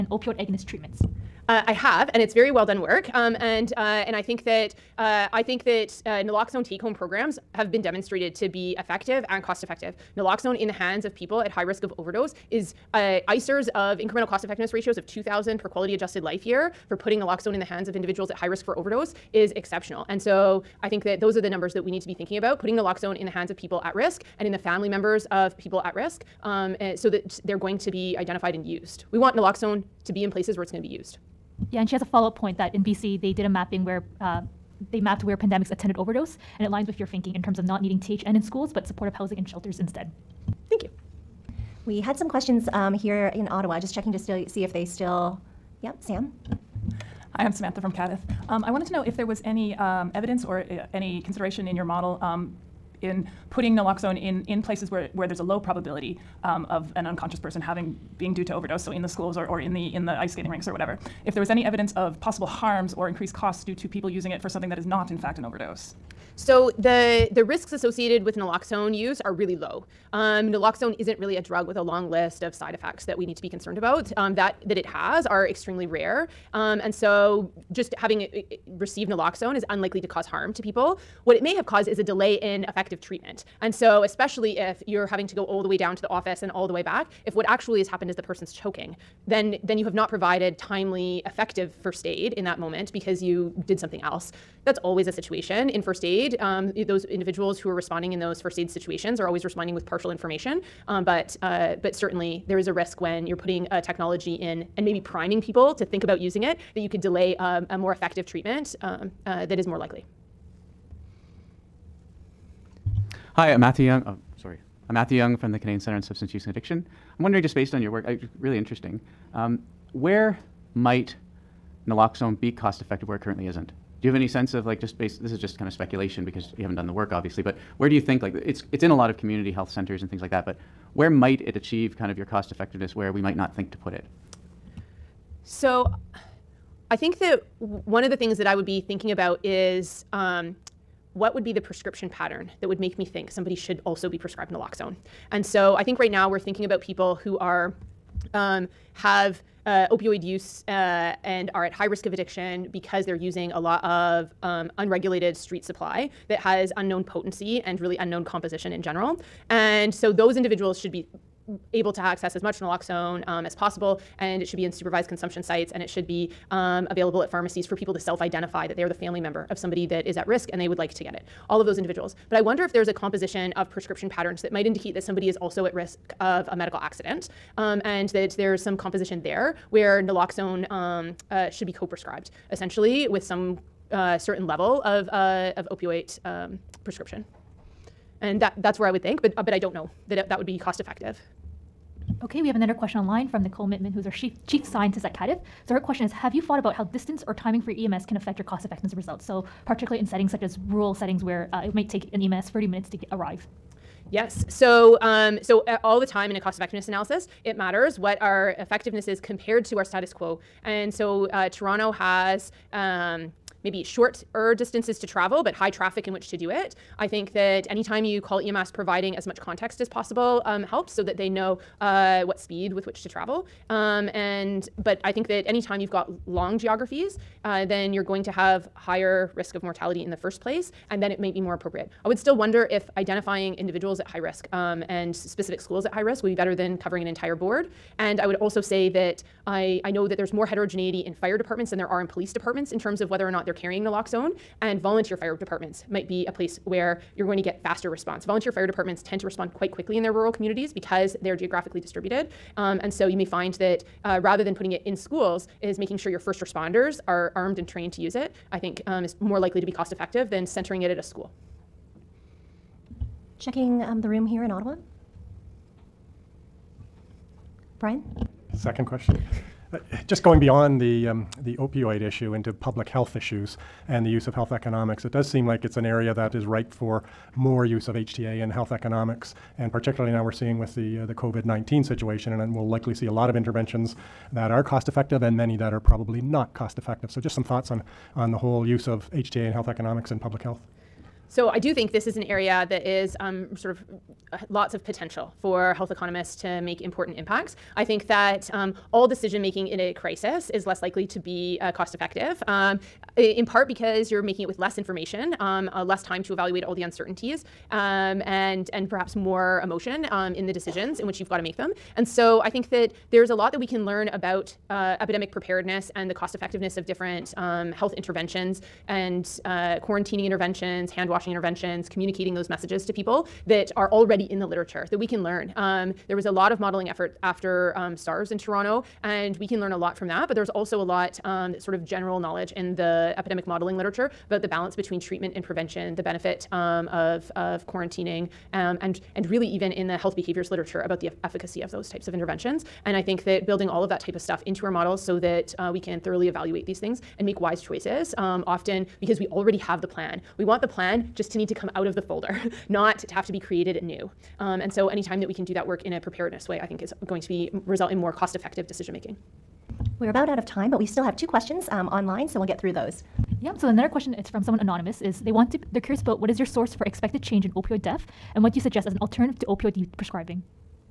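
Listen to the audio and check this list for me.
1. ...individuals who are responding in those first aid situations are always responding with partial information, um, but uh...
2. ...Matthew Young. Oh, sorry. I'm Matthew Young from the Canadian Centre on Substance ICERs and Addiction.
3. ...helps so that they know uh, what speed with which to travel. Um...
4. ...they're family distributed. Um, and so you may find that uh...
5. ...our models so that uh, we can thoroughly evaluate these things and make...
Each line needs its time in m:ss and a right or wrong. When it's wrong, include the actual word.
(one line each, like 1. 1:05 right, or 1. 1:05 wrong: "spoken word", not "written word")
1. 1:37 right
2. 1:53 wrong: "Use", not "ICERs"
3. 3:40 right
4. 4:11 wrong: "geographically", not "family"
5. 5:44 right.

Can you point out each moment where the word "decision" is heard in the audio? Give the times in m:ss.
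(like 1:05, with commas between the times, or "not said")
4:59, 5:10, 5:58.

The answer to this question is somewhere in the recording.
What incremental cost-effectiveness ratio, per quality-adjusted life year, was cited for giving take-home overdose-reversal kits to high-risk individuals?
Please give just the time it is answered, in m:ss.
0:15.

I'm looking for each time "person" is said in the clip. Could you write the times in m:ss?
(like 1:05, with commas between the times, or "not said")
0:57, 1:28.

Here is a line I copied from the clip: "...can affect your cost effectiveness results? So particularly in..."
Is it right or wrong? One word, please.
right.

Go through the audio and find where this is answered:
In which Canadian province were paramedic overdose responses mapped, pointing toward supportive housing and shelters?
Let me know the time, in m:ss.
0:32.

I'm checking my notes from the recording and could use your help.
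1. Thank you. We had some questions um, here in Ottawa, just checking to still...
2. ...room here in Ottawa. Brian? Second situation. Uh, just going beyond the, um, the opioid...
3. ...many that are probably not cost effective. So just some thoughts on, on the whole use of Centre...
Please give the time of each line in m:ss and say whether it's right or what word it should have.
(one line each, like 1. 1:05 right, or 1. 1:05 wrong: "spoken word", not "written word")
1. 0:40 right
2. 4:24 wrong: "question", not "situation"
3. 4:45 wrong: "HTA", not "Centre".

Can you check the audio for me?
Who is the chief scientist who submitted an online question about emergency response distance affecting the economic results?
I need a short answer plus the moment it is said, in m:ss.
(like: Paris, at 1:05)
Nicole Mittmann, at 3:13.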